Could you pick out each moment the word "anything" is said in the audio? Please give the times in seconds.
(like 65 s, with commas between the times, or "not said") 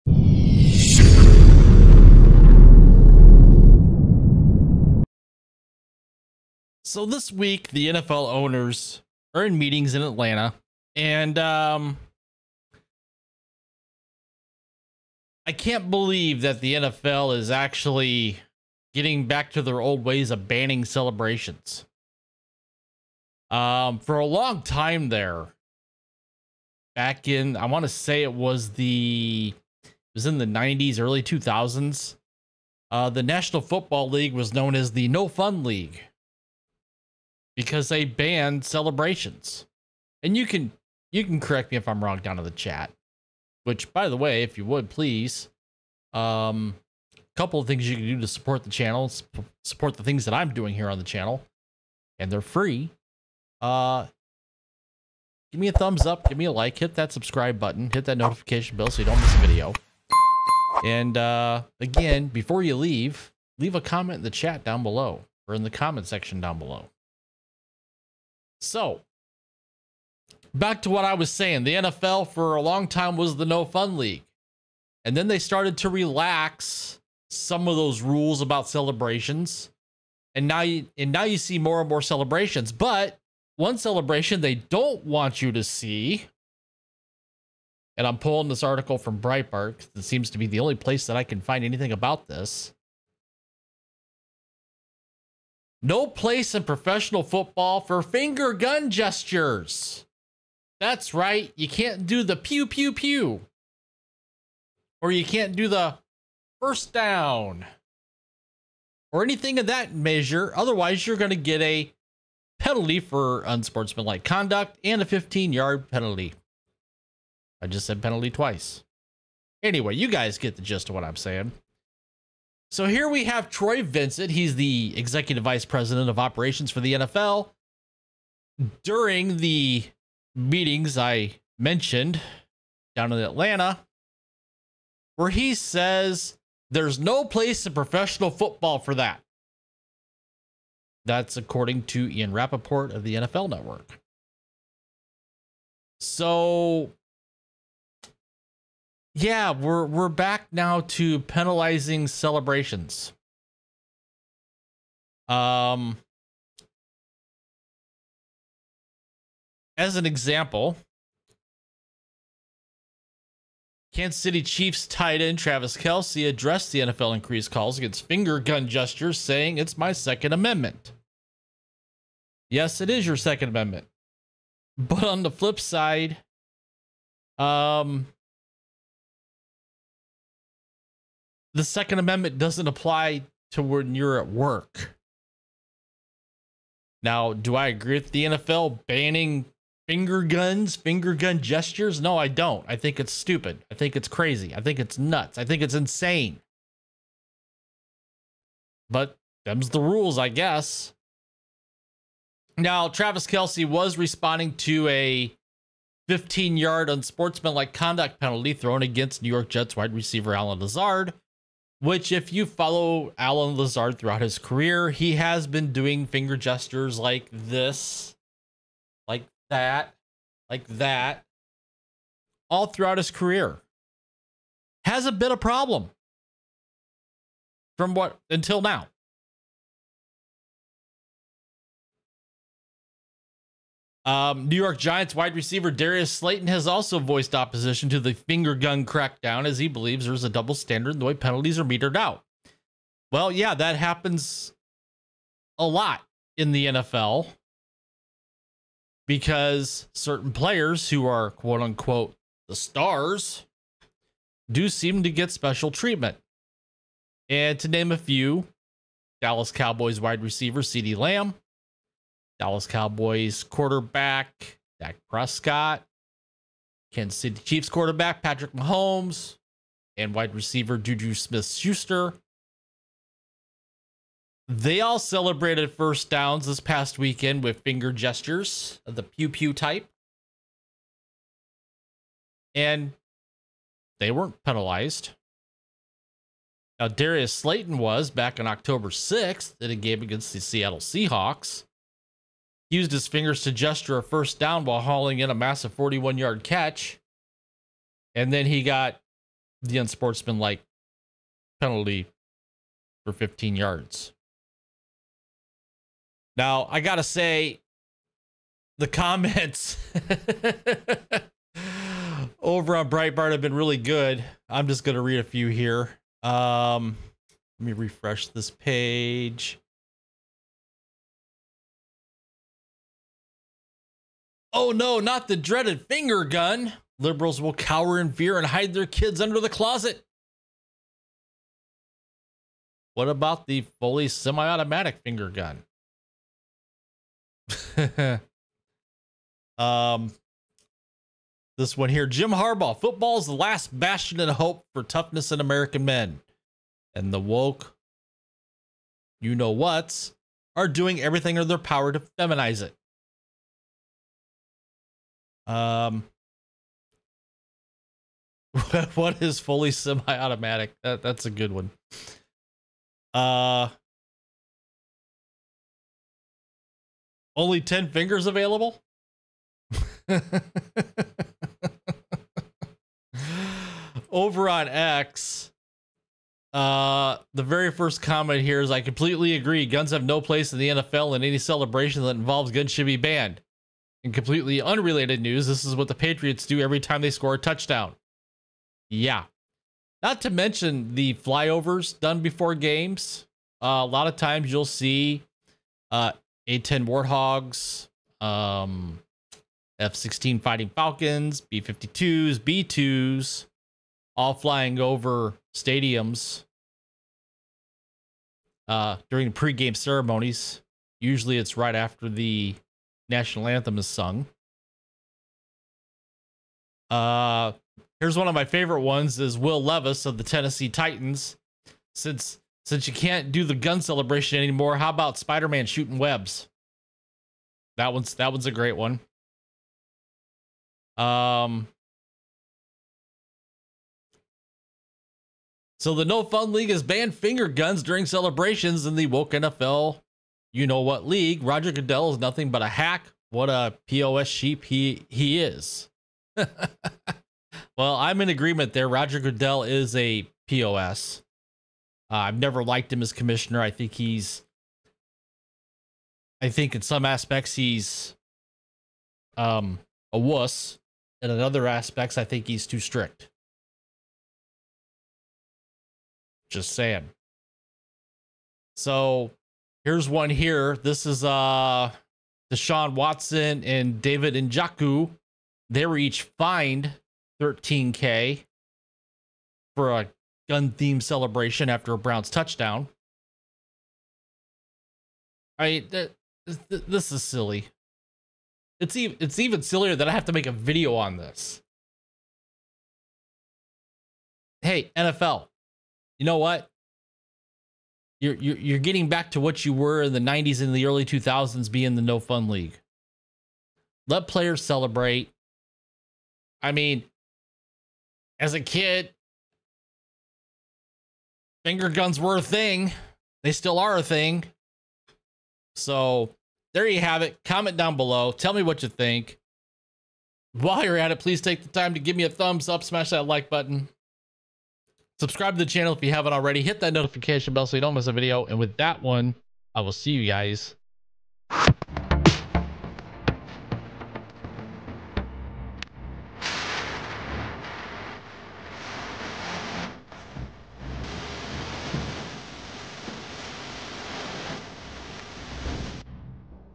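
91 s, 109 s.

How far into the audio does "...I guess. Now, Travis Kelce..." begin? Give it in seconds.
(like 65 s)
200 s.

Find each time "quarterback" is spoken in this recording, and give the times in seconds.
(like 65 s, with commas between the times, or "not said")
263 s, 267 s.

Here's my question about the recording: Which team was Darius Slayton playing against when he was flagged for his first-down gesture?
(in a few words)
Seattle Seahawks.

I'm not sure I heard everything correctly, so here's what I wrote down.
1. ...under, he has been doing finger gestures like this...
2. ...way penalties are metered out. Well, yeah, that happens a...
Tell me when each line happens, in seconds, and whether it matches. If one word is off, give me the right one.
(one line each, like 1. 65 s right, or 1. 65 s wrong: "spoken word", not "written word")
1. 214 s wrong: "career", not "under"
2. 241 s right.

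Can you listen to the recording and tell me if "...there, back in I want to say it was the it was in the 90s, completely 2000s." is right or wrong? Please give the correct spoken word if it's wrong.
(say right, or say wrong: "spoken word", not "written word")
wrong: "early", not "completely".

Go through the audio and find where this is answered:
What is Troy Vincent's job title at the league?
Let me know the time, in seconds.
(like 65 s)
124 s.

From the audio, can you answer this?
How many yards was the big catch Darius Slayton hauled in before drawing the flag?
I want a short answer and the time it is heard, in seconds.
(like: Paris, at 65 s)
41 yards, at 295 s.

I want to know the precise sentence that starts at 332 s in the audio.
What about the fully semi automatic finger gun?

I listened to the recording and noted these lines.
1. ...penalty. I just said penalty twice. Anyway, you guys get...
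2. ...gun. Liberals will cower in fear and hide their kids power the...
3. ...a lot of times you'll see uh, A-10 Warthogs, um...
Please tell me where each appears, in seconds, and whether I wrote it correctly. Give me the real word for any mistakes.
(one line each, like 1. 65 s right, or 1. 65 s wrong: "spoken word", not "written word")
1. 115 s right
2. 326 s wrong: "under", not "power"
3. 393 s right.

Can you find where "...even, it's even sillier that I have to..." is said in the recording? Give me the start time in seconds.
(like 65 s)
488 s.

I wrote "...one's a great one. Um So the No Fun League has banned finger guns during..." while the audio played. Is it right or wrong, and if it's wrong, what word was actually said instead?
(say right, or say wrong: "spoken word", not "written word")
right.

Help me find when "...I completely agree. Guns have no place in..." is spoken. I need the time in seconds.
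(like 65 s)
378 s.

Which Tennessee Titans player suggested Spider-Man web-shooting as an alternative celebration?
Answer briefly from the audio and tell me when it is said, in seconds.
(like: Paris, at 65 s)
Will Levis, at 419 s.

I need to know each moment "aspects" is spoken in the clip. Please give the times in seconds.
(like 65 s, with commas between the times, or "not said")
457 s, 461 s.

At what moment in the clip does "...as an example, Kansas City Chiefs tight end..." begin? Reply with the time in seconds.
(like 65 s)
159 s.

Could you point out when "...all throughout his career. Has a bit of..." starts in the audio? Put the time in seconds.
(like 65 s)
222 s.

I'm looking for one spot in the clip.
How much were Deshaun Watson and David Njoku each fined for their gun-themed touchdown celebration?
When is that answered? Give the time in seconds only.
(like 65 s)
477 s.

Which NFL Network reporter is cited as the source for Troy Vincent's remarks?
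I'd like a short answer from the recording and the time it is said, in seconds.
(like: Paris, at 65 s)
Ian Rapoport, at 142 s.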